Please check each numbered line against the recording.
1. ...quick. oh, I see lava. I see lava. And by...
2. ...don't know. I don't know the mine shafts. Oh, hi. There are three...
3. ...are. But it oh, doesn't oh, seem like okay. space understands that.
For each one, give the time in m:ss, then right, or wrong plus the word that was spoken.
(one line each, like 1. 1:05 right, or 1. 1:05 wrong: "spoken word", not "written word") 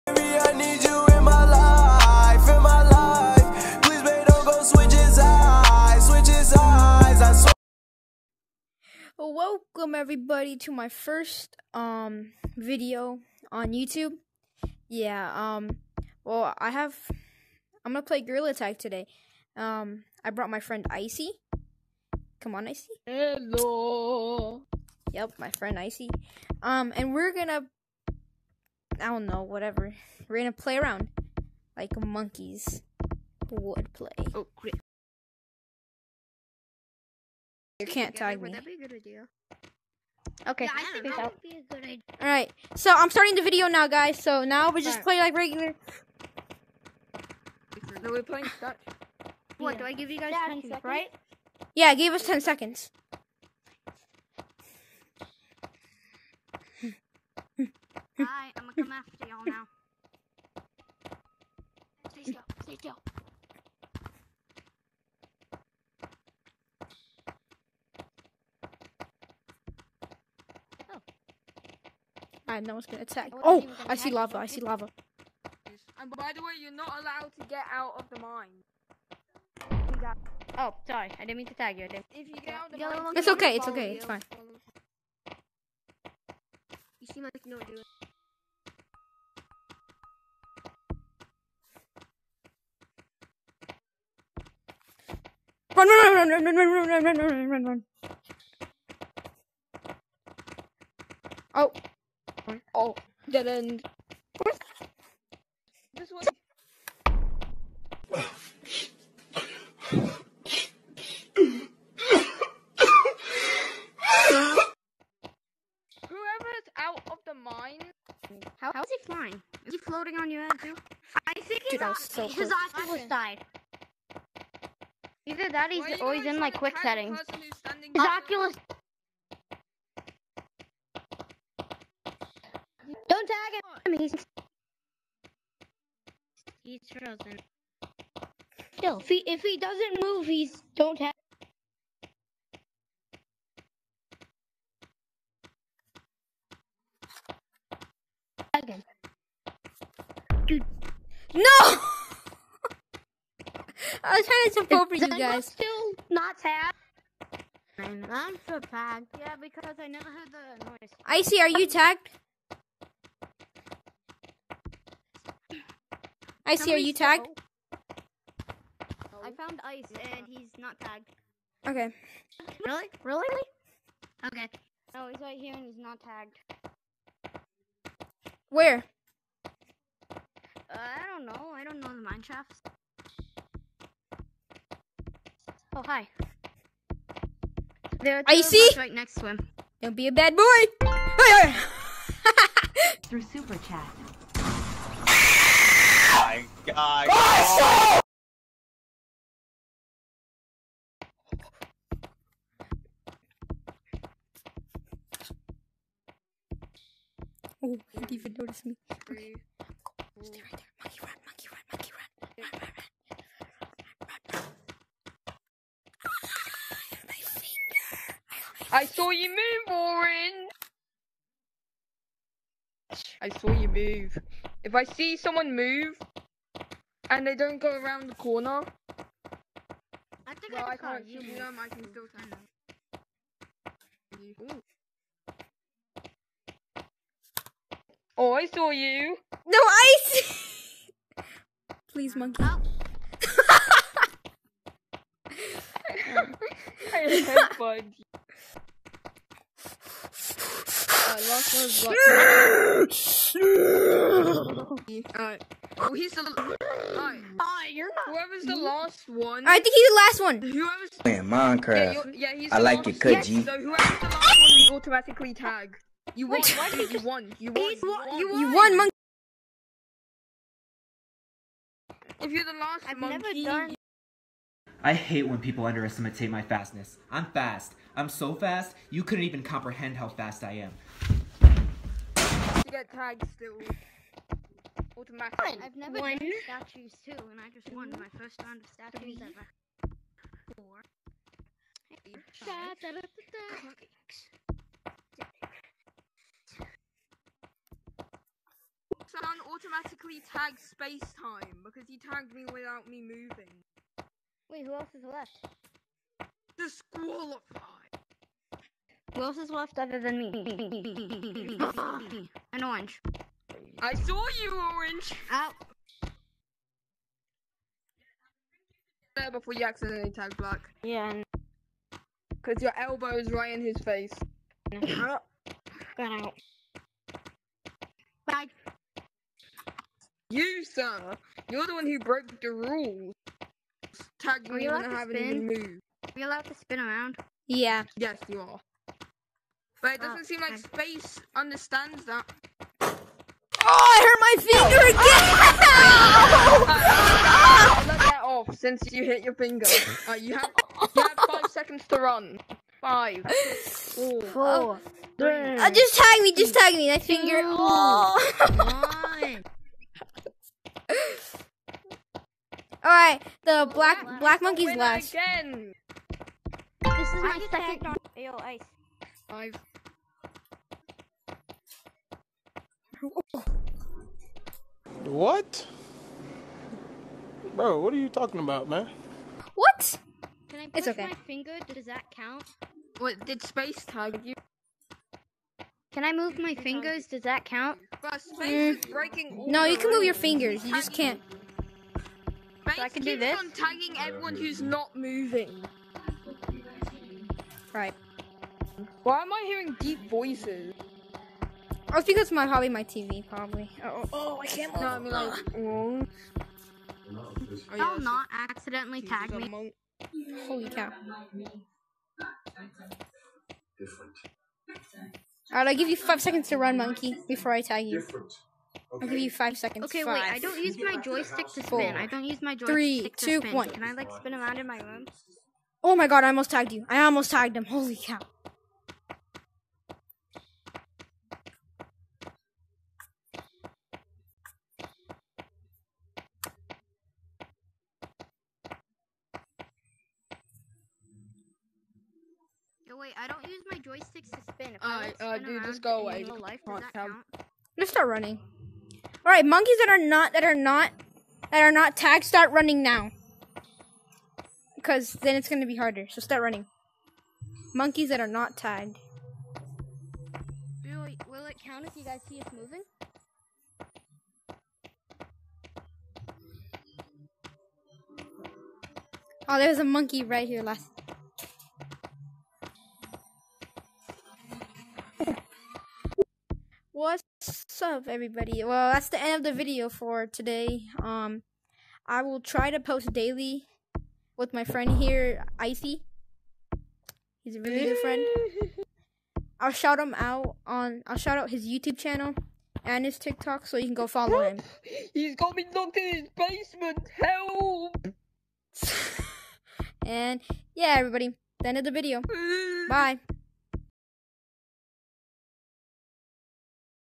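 1. 1:13 wrong: "attack", not "quick"
2. 3:01 wrong: "two", not "three"
3. 5:38 right.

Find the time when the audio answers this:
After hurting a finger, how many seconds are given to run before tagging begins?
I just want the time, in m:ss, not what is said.
5:50.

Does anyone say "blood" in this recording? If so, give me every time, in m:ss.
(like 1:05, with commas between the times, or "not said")
4:14.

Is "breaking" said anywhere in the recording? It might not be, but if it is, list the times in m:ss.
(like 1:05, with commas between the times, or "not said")
6:28.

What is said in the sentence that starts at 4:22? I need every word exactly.
Yeah, yeah, I like it, cut So whoever's the last one, we automatically tag.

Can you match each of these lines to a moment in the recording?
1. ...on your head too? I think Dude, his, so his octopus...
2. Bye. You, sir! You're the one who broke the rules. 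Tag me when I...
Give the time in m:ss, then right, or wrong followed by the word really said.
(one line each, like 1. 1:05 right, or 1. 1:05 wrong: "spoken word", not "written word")
1. 2:00 right
2. 5:28 right.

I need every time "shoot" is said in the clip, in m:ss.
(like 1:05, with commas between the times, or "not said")
3:51.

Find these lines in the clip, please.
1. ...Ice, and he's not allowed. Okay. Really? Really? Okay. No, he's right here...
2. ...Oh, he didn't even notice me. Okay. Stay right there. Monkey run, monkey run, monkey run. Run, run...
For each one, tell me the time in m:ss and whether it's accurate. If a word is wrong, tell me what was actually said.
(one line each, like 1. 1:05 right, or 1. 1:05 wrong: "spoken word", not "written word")
1. 2:49 wrong: "tagged", not "allowed"
2. 3:27 right.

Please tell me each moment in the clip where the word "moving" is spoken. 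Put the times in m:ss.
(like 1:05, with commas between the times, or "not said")
5:03, 6:34, 7:42.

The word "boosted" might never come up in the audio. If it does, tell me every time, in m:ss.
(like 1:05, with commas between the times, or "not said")
not said.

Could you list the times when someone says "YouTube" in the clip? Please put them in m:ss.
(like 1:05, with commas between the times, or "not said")
0:13, 8:11.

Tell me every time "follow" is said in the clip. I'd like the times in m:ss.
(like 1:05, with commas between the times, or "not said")
8:14.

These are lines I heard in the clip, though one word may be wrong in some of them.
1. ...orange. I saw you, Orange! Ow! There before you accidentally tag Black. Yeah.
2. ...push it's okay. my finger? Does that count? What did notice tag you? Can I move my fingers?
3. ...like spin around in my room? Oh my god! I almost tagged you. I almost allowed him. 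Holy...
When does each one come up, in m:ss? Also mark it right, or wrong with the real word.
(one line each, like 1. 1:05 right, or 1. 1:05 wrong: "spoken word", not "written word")
1. 5:12 right
2. 6:20 wrong: "space", not "notice"
3. 7:03 wrong: "tagged", not "allowed".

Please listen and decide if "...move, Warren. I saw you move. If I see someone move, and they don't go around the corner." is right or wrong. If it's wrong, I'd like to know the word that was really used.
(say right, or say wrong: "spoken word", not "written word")
right.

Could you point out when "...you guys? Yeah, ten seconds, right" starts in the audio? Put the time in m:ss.
0:50.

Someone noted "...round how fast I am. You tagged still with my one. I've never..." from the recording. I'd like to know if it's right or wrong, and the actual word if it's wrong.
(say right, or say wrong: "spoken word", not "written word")
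wrong: "comprehend", not "round".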